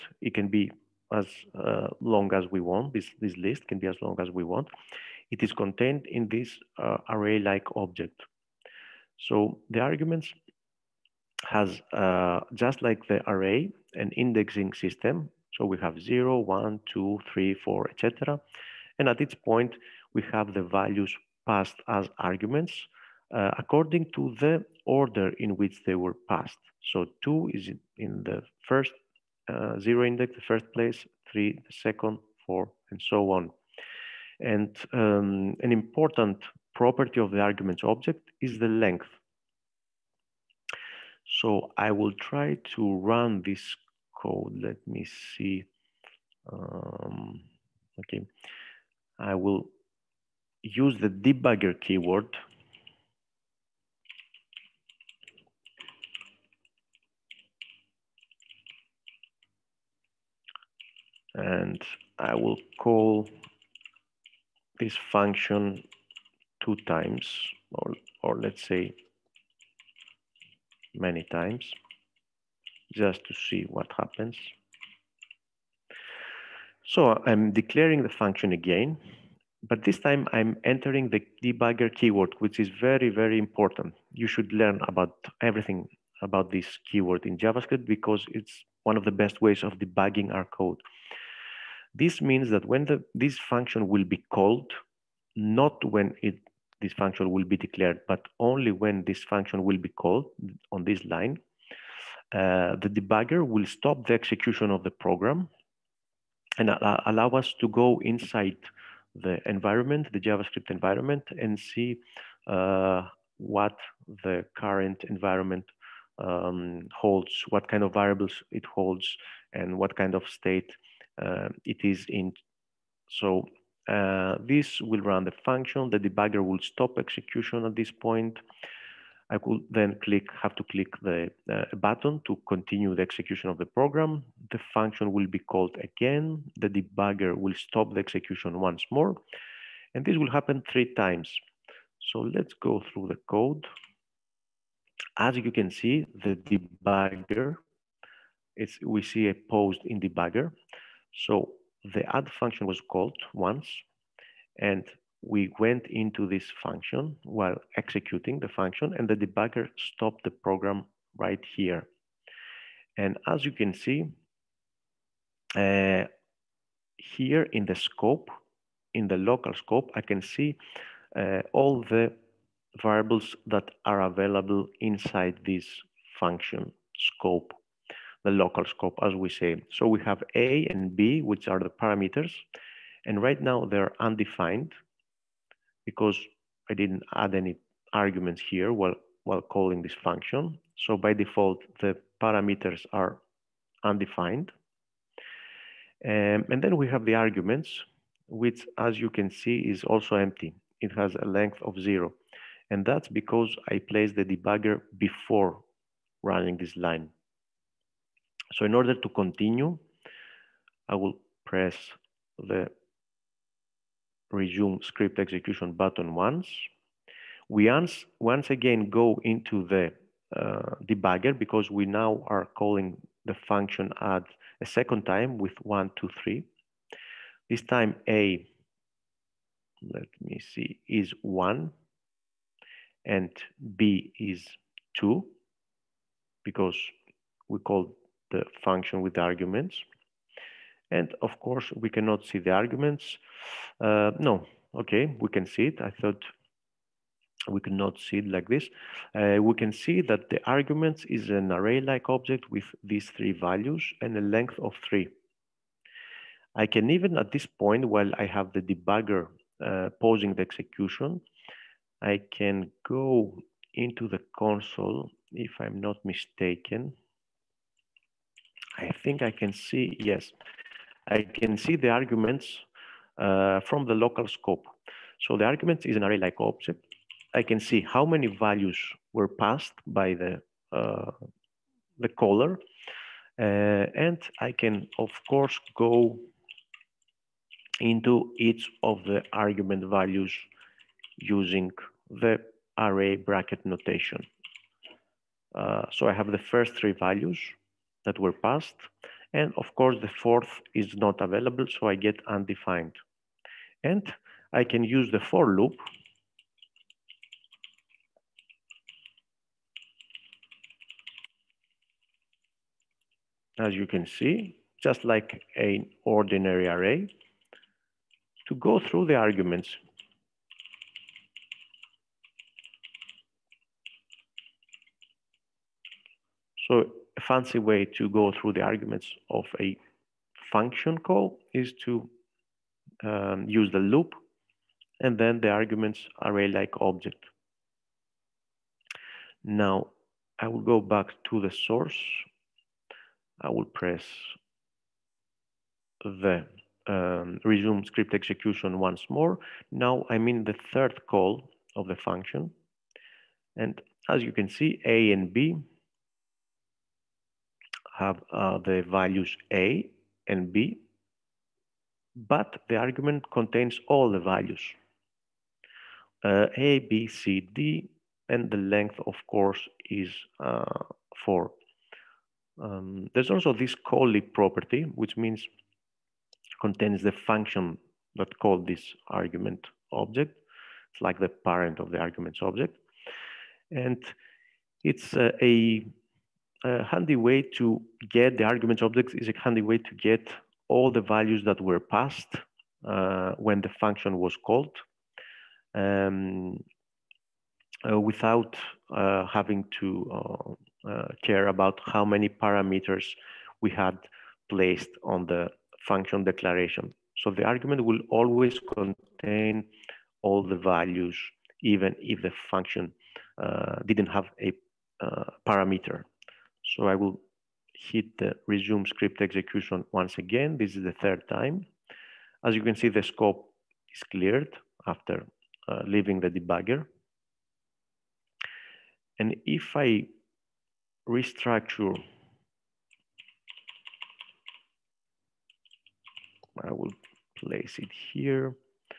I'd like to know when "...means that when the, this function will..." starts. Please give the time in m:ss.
1:32.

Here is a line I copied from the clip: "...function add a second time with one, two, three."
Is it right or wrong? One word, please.
right.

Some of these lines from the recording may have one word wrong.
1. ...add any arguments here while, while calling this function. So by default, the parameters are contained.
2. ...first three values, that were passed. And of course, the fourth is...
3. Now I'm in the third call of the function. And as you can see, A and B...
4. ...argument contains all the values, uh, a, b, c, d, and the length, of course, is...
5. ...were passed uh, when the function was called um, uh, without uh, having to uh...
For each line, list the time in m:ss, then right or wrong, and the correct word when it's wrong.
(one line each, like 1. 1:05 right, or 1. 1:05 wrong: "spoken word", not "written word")
1. 3:07 wrong: "undefined", not "contained"
2. 4:56 right
3. 5:49 right
4. 6:02 right
5. 6:31 right.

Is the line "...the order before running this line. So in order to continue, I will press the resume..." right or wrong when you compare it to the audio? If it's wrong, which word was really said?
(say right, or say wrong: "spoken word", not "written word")
wrong: "debugger", not "order".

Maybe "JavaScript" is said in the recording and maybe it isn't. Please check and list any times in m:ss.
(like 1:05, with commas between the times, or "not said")
1:27, 1:50.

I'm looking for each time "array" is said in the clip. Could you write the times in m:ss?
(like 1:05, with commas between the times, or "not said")
0:07, 0:13, 4:11, 4:36, 4:52, 5:16, 5:36.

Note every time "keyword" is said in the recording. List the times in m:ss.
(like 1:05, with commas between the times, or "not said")
0:51, 1:21, 1:26.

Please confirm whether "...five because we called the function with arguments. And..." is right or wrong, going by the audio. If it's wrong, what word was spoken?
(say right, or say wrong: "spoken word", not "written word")
wrong: "two", not "five".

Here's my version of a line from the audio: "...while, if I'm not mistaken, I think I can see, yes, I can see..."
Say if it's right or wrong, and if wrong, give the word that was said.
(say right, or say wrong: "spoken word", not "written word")
wrong: "console", not "while".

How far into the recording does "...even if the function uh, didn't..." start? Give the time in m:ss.
6:51.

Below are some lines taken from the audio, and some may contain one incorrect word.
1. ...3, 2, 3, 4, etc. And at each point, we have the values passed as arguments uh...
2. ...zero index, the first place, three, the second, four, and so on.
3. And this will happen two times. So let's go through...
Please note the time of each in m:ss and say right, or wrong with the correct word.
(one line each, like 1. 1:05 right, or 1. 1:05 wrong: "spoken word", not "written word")
1. 0:16 wrong: "1", not "3"
2. 0:29 right
3. 2:19 wrong: "three", not "two".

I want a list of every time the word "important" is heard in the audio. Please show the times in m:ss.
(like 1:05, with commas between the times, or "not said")
0:35, 1:23.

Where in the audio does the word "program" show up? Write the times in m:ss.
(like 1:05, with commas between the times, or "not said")
1:44, 2:13, 2:40.